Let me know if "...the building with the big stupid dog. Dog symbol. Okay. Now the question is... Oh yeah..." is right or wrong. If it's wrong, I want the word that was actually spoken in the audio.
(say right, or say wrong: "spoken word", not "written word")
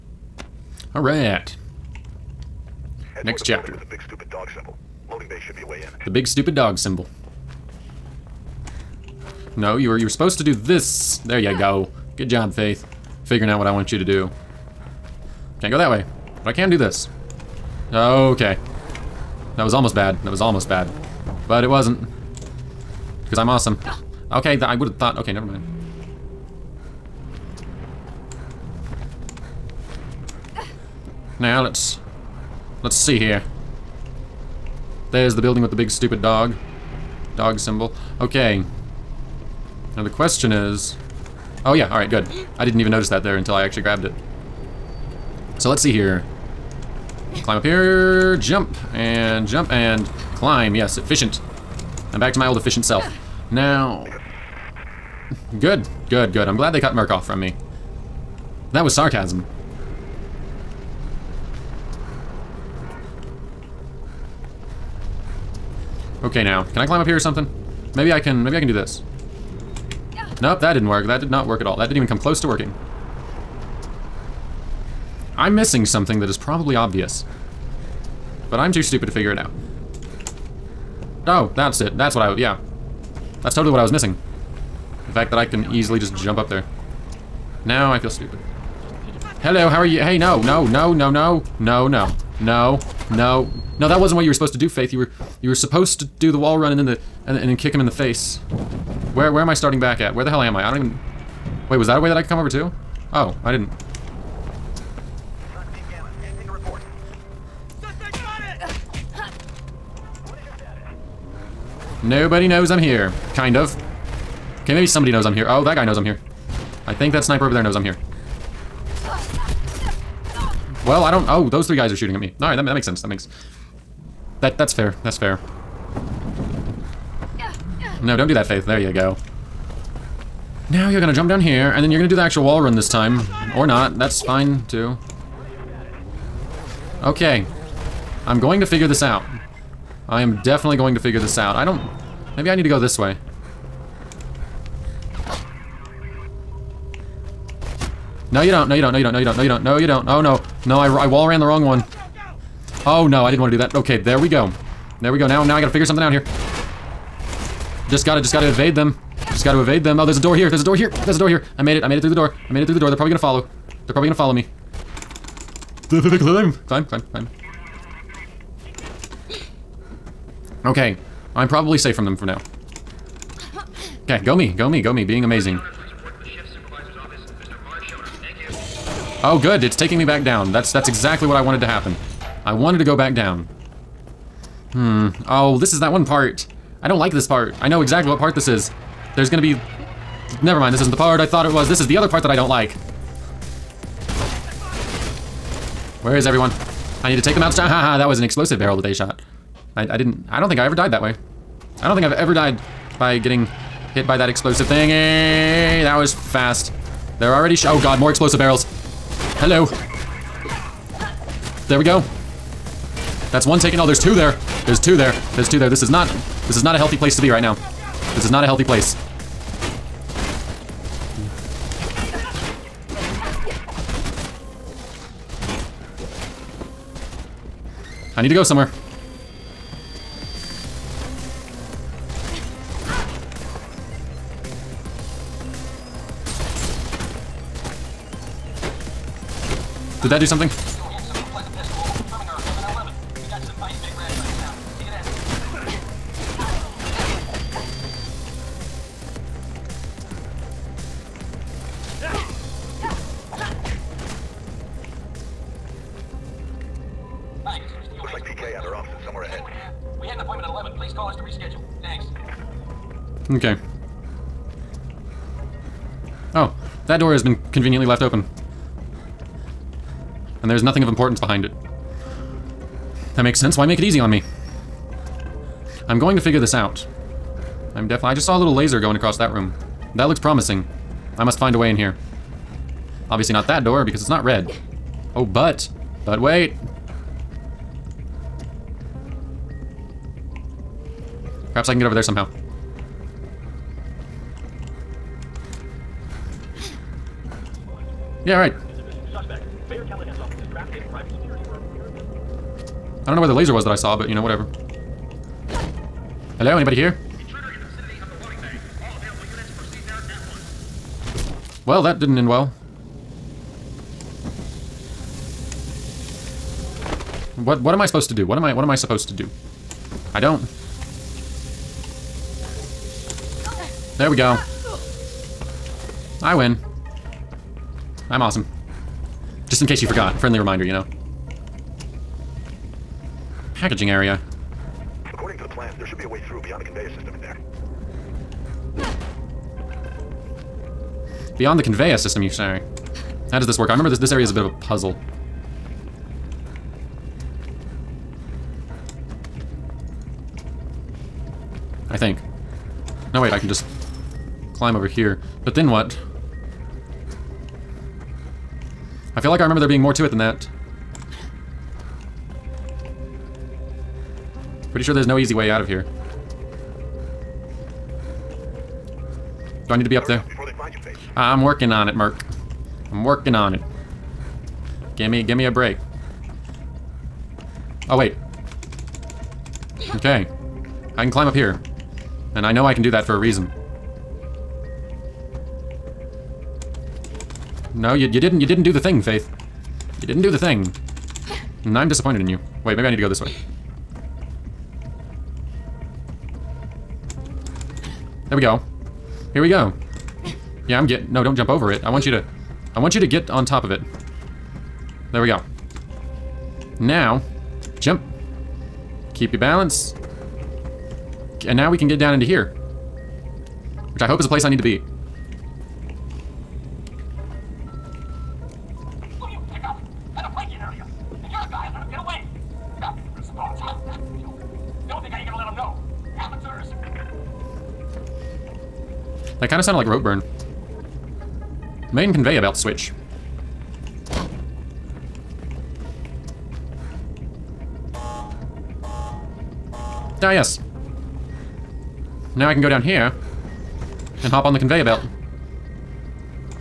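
right.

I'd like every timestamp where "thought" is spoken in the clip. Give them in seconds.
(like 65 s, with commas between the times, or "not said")
24 s, 191 s.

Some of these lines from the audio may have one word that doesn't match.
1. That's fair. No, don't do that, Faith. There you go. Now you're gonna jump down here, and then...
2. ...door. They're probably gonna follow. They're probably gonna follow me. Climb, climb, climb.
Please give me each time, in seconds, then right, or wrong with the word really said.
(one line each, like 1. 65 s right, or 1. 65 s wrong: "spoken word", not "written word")
1. 125 s right
2. 162 s right.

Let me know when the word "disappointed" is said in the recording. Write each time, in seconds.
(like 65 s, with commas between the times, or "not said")
391 s.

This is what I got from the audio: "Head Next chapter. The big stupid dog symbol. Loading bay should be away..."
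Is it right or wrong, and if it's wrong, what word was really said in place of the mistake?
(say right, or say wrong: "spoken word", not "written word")
right.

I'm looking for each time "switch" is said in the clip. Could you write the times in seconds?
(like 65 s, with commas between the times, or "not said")
432 s.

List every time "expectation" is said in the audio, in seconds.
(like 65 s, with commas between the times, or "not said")
not said.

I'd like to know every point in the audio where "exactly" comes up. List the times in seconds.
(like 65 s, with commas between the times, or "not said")
180 s, 187 s.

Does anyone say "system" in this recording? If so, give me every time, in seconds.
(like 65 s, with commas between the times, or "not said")
336 s, 341 s.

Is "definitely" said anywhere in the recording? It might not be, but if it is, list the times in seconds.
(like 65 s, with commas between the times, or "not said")
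140 s, 277 s.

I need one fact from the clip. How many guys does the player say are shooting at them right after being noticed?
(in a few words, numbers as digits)
3.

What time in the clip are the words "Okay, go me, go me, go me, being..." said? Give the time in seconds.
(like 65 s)
174 s.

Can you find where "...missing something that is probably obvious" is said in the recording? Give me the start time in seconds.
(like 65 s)
75 s.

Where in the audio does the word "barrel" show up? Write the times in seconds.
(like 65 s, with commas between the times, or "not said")
198 s, 208 s.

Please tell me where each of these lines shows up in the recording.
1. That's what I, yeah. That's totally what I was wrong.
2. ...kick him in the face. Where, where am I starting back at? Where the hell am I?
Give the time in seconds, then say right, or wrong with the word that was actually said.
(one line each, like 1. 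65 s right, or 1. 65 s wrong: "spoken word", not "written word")
1. 81 s wrong: "missing", not "wrong"
2. 97 s right.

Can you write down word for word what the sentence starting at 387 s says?
No, you you didn't you didn't do the thing, Faith.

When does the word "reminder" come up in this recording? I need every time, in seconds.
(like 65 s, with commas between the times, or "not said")
330 s.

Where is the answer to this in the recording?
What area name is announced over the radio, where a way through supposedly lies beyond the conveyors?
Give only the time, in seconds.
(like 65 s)
333 s.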